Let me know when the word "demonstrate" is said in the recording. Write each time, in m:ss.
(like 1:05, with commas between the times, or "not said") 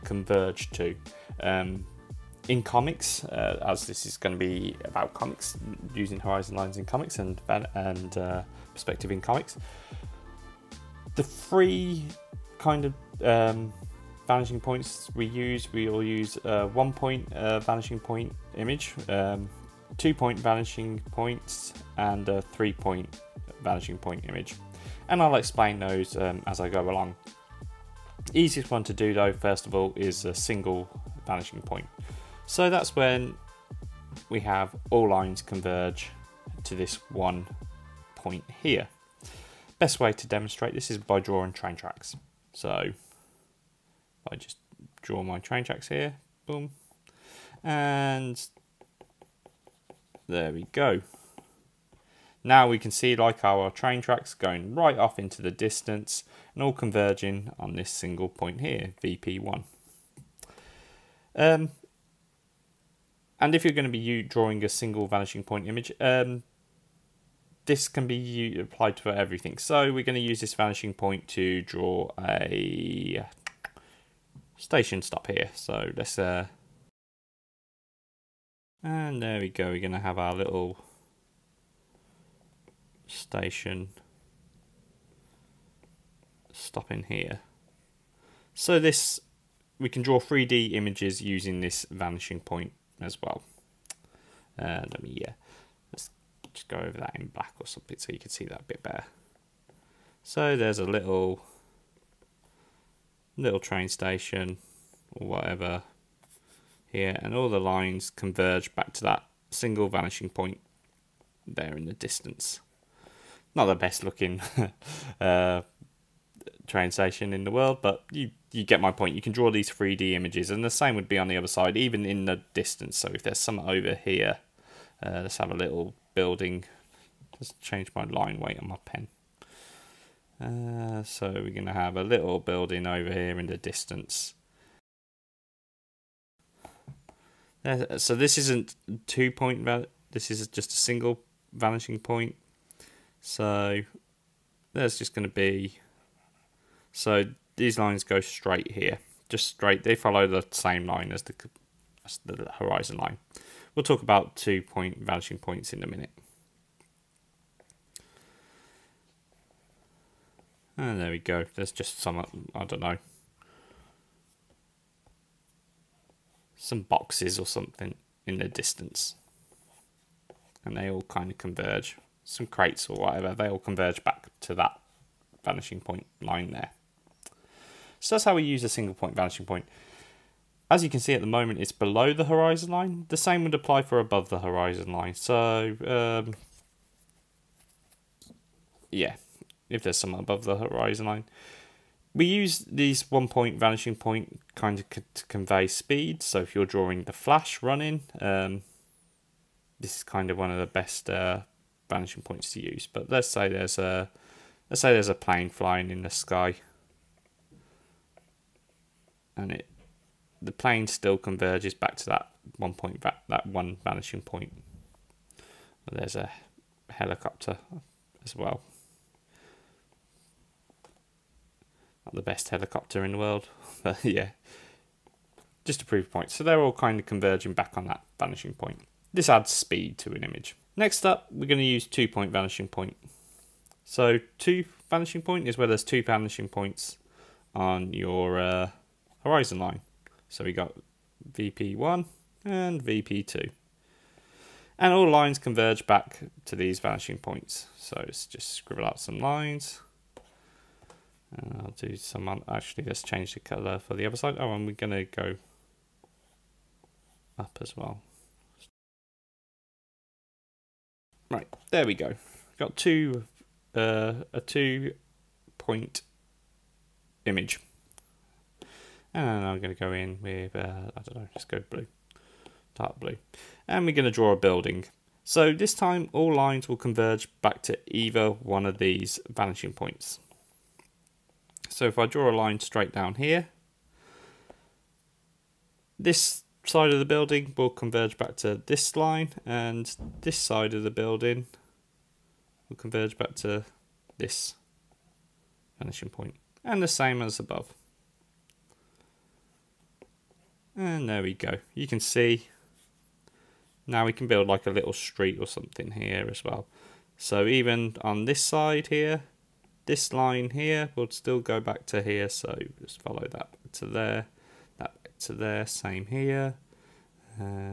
0:40.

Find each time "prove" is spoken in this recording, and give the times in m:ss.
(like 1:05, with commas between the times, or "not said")
3:45.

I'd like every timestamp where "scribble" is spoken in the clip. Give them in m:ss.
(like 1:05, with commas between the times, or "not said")
4:08.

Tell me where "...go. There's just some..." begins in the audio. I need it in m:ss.
2:41.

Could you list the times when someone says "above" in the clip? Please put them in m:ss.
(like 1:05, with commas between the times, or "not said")
3:04, 3:10, 4:57.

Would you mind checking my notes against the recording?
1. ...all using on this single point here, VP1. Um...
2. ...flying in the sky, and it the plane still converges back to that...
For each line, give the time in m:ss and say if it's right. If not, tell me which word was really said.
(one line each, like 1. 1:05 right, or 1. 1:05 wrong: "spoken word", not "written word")
1. 0:56 wrong: "converging", not "using"
2. 3:25 right.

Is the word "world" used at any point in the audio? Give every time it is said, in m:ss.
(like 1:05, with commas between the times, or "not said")
1:57, 3:43.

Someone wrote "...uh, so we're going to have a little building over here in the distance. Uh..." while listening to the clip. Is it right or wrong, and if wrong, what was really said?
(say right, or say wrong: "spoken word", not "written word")
right.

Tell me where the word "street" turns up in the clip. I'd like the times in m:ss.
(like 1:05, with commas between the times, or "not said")
5:04.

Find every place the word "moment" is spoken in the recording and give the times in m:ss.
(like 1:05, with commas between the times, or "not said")
3:01.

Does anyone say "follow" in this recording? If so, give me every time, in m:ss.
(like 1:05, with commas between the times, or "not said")
2:29, 5:13.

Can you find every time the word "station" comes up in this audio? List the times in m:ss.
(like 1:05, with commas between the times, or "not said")
1:14, 1:23, 1:43, 1:56.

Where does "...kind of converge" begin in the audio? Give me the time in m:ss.
2:51.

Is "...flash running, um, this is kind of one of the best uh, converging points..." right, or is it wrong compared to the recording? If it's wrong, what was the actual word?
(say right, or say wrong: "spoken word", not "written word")
wrong: "vanishing", not "converging".